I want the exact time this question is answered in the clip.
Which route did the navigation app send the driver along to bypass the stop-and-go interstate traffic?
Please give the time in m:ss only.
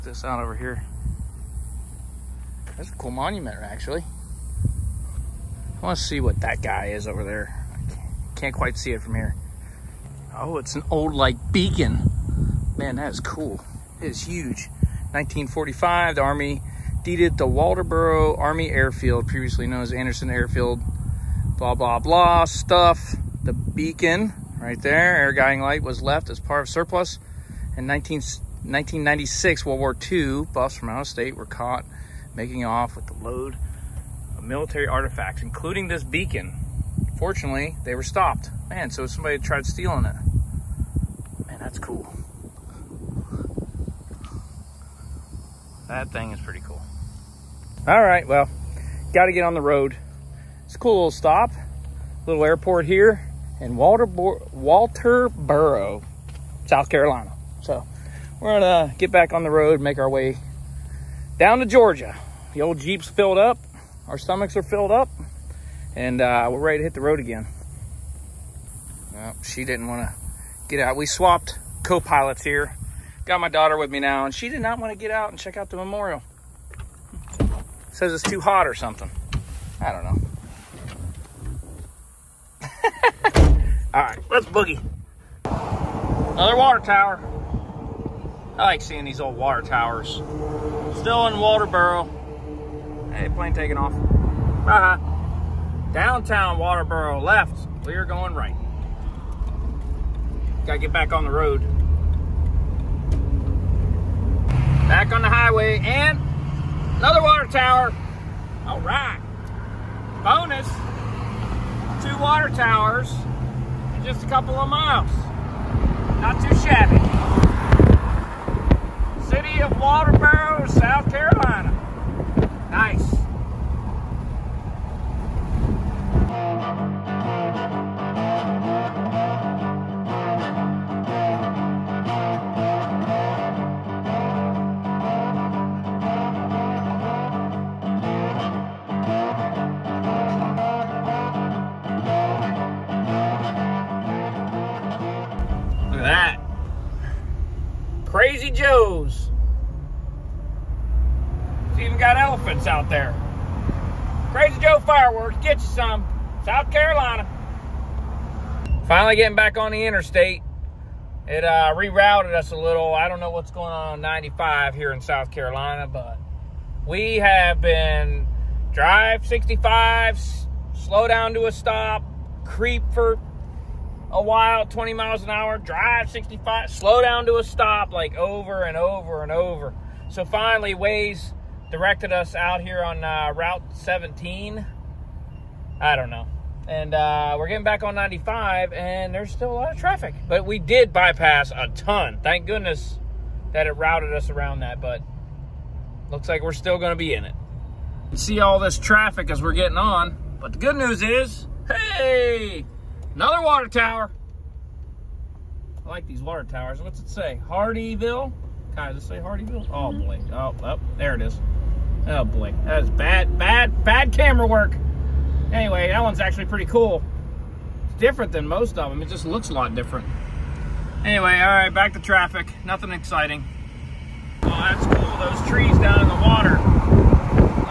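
3:03.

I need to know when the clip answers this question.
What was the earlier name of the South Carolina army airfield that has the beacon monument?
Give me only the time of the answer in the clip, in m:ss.
0:19.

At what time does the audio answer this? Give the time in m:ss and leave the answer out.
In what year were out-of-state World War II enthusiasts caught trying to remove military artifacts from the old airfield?
0:28.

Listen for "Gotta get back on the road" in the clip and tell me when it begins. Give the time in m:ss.
1:40.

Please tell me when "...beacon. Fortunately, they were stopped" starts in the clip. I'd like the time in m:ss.
0:36.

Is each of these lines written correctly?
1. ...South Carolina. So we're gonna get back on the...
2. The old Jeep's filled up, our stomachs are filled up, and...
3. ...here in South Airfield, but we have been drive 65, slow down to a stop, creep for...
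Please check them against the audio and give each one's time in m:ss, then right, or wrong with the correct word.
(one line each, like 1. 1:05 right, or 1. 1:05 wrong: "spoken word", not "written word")
1. 0:56 right
2. 1:02 right
3. 2:44 wrong: "Carolina", not "Airfield".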